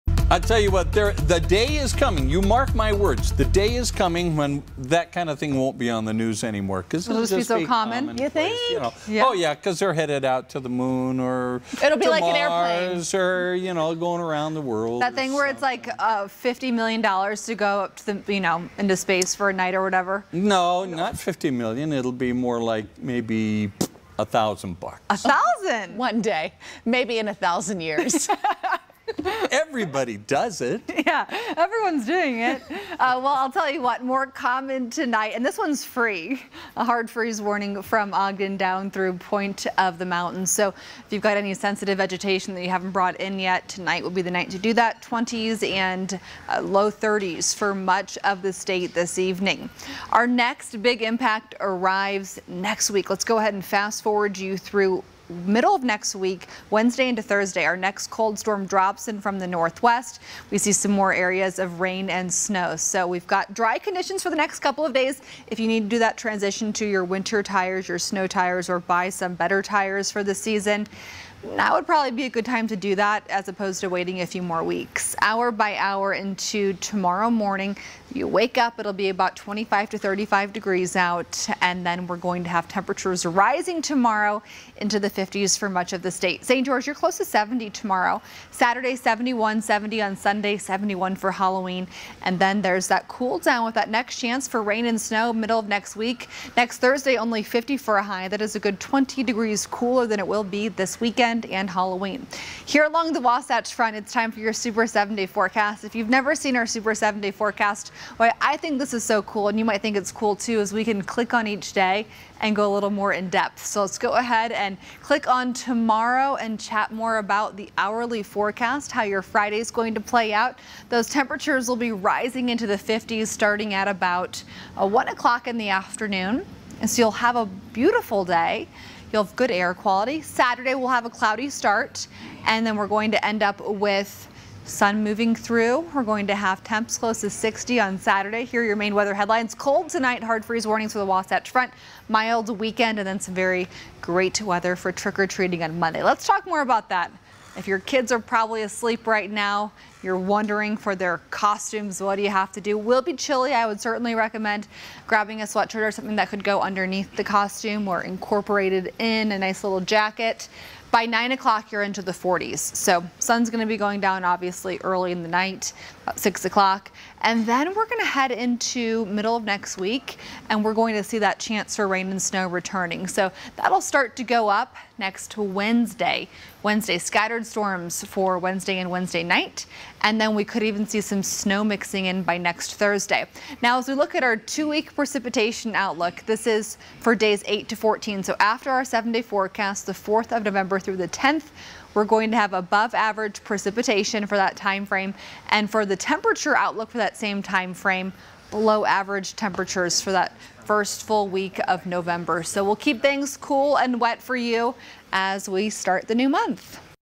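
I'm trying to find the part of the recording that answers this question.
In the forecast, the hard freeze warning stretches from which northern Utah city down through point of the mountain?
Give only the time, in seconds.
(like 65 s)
38 s.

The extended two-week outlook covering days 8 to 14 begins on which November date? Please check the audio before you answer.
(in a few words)
November 4.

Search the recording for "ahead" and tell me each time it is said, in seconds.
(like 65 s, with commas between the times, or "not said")
53 s, 114 s.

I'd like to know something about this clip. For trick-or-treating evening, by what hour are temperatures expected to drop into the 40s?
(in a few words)
9 o'clock.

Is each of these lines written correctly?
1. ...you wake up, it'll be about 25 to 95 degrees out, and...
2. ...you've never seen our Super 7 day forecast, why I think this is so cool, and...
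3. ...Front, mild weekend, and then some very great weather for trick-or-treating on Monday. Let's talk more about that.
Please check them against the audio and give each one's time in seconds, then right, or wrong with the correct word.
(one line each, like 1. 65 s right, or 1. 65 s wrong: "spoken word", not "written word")
1. 78 s wrong: "35", not "95"
2. 105 s right
3. 141 s right.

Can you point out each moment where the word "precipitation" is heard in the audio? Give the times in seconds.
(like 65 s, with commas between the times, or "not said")
184 s, 193 s.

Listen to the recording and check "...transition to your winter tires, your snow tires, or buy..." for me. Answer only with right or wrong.
right.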